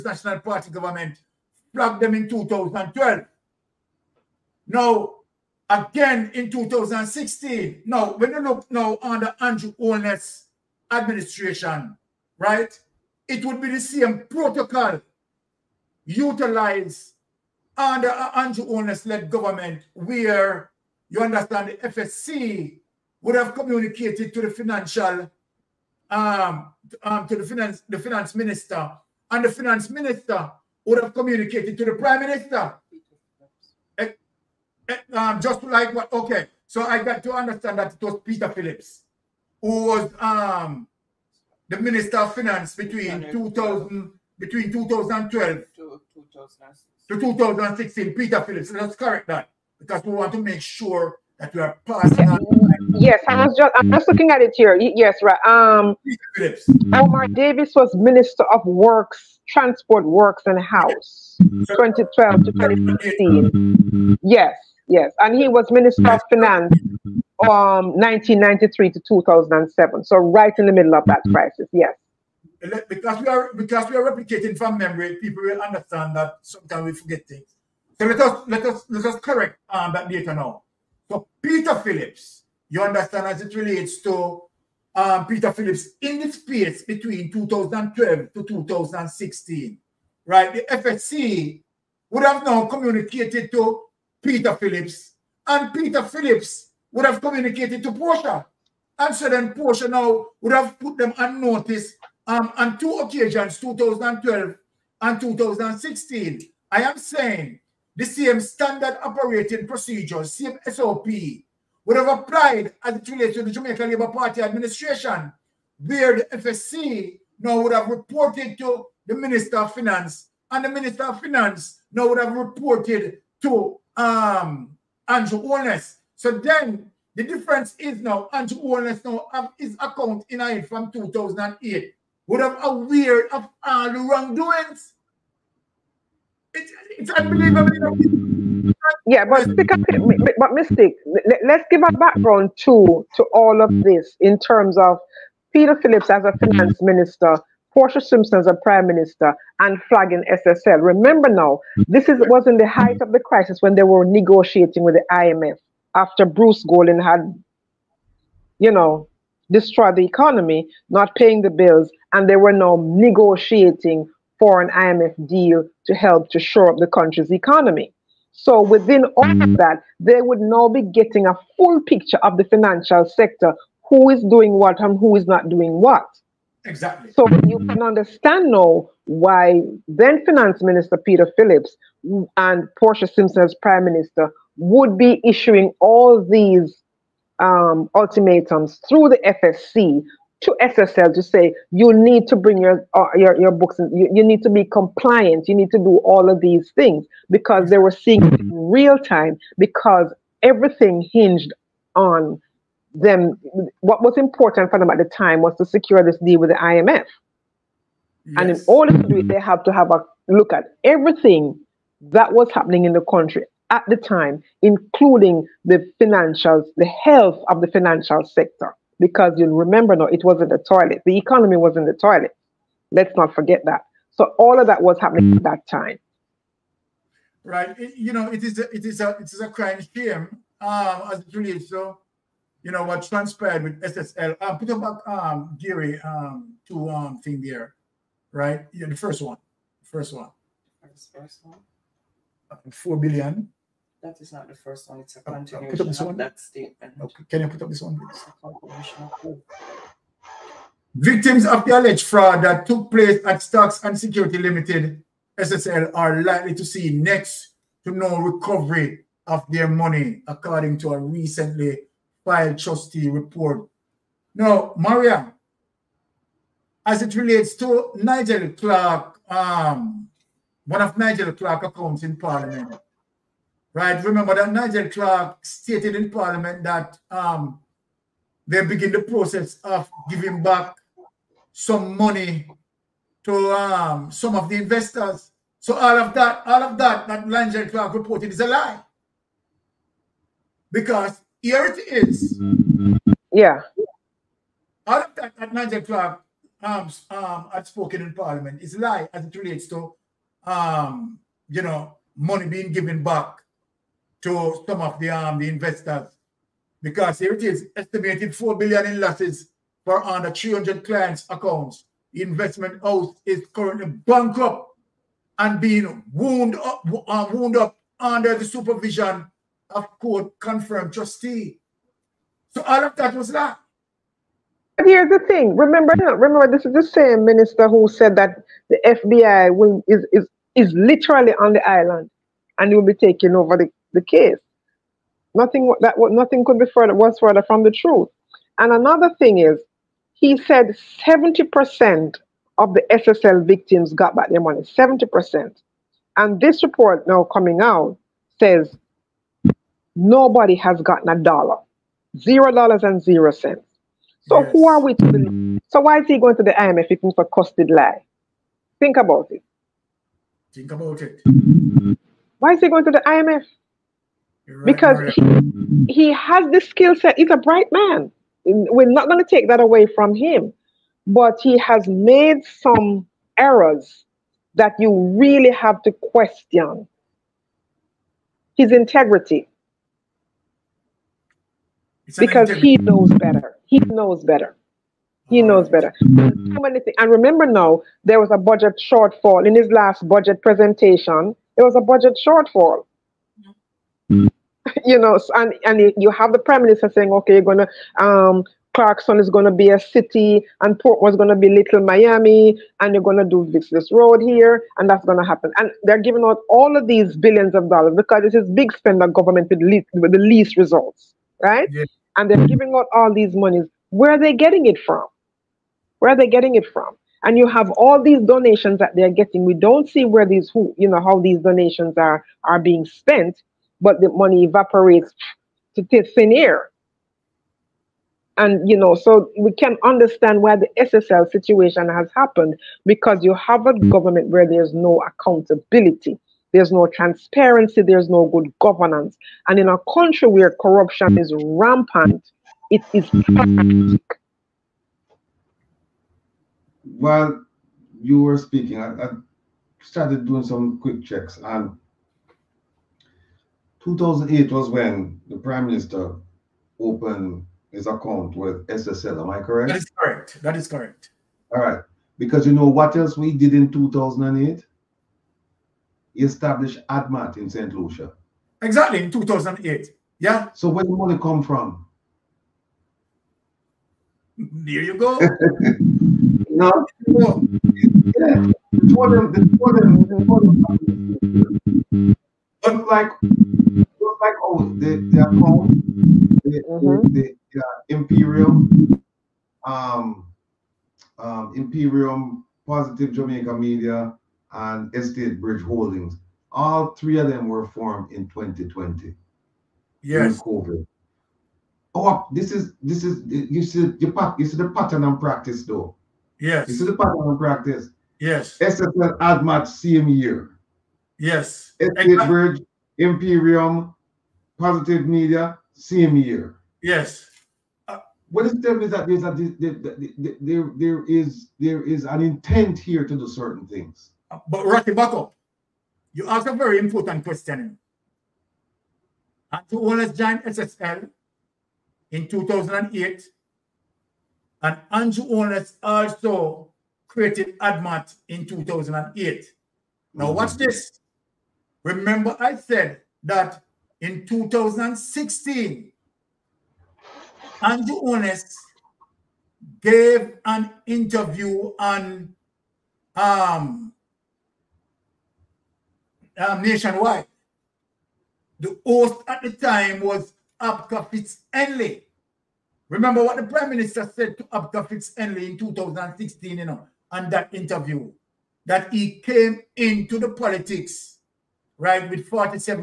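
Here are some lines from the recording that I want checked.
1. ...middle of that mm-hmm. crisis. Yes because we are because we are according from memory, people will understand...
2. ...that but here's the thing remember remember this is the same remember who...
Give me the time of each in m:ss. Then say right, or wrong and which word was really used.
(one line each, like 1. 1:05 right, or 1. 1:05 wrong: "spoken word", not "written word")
1. 1:10 wrong: "replicating", not "according"
2. 5:23 wrong: "minister", not "remember".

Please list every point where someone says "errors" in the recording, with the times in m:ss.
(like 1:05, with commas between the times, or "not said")
6:13.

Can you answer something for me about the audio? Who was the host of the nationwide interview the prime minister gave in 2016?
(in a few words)
Abka Fitz-Henley.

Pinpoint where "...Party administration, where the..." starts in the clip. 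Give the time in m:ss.
1:54.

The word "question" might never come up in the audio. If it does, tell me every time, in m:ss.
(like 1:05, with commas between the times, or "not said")
6:15, 8:47.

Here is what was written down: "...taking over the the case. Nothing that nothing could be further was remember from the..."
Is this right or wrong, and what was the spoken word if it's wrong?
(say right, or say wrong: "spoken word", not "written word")
wrong: "further", not "remember".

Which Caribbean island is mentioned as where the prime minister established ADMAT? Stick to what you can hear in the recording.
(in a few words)
St. Lucia.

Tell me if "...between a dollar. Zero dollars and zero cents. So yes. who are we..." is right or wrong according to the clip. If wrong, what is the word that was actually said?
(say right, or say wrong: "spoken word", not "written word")
wrong: "gotten", not "between".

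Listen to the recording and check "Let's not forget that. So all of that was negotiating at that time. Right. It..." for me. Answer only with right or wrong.
wrong.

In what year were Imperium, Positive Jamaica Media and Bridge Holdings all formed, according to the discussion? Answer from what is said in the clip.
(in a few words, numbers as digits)
2020.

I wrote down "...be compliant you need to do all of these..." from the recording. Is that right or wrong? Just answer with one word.
right.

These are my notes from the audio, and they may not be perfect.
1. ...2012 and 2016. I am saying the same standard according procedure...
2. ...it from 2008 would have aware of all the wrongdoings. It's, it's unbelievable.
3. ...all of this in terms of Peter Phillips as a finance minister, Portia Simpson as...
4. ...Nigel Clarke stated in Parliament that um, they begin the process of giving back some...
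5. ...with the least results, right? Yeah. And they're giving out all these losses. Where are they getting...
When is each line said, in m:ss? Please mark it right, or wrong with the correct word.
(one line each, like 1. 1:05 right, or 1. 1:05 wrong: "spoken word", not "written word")
1. 1:43 wrong: "operating", not "according"
2. 2:10 right
3. 2:23 right
4. 4:34 right
5. 6:49 wrong: "monies", not "losses".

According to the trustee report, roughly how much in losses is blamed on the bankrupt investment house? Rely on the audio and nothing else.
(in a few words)
4 billion.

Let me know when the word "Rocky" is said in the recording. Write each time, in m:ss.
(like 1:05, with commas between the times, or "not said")
8:44.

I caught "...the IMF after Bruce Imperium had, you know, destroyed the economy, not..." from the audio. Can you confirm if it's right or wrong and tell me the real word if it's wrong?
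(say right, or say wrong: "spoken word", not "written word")
wrong: "Golding", not "Imperium".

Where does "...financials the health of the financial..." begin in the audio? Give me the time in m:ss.
3:35.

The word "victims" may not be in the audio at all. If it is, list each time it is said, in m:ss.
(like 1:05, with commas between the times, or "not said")
4:10, 5:43.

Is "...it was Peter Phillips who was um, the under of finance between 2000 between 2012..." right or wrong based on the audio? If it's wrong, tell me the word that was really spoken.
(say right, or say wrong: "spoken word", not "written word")
wrong: "minister", not "under".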